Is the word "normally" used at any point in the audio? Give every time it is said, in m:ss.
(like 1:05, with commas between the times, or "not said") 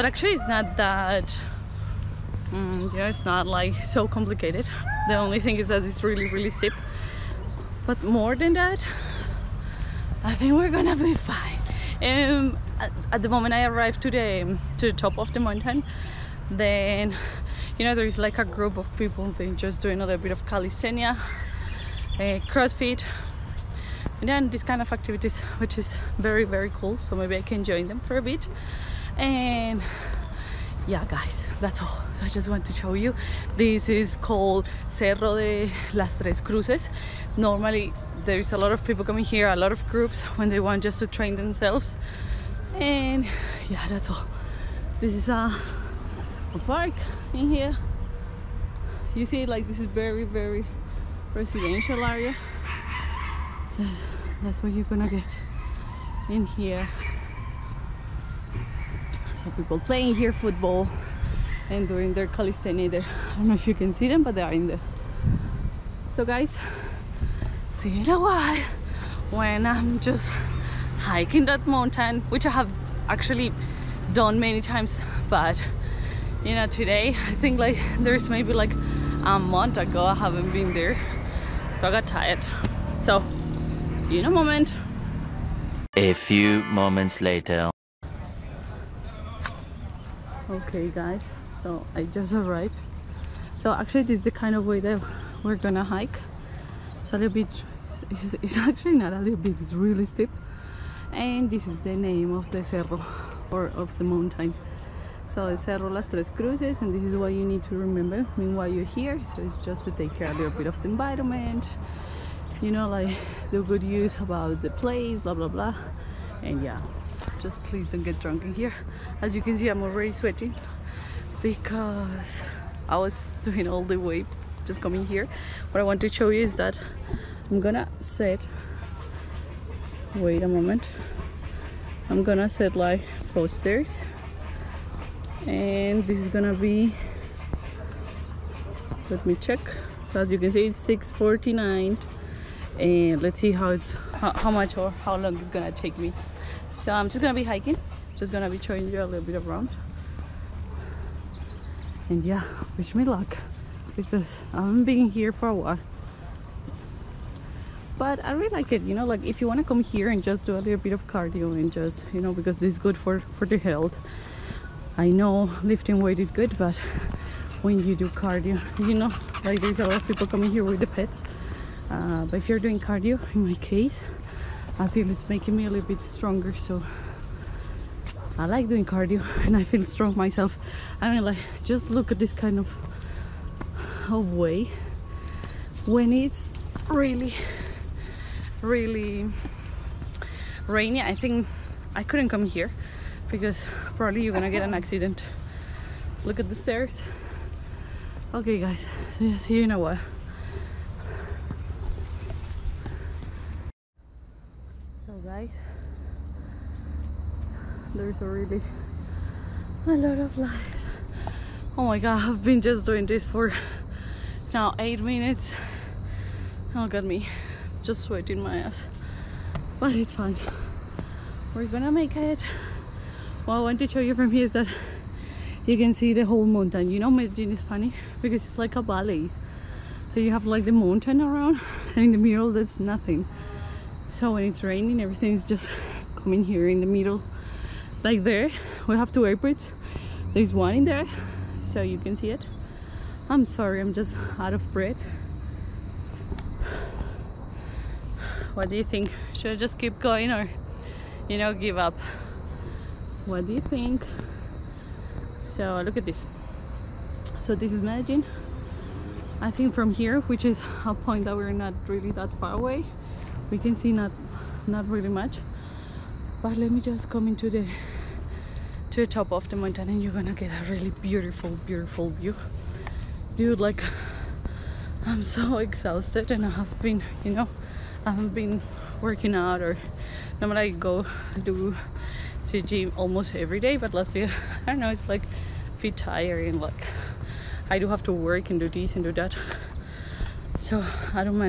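0:37, 4:40.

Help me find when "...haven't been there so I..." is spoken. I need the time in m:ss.
1:20.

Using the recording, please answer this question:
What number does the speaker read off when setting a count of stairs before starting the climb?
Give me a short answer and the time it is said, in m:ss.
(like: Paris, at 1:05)
649, at 2:20.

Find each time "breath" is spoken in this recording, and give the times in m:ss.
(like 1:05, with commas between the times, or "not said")
4:04.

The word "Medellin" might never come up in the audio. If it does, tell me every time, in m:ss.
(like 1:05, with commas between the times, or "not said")
3:47, 4:17.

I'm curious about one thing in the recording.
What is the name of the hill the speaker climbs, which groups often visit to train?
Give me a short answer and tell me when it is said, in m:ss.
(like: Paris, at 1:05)
Cerro de las Tres Cruces, at 0:34.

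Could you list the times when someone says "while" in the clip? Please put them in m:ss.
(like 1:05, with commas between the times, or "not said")
1:08, 1:48, 2:35, 3:19.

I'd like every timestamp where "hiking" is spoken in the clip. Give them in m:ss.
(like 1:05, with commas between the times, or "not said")
1:10, 2:27.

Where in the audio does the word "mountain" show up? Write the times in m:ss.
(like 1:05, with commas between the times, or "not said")
0:15, 1:11, 1:44, 3:46, 3:50, 4:29.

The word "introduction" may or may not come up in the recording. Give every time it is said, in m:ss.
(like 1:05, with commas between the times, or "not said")
not said.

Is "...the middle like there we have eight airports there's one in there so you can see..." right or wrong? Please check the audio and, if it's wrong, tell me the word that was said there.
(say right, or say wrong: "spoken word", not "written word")
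wrong: "two", not "eight".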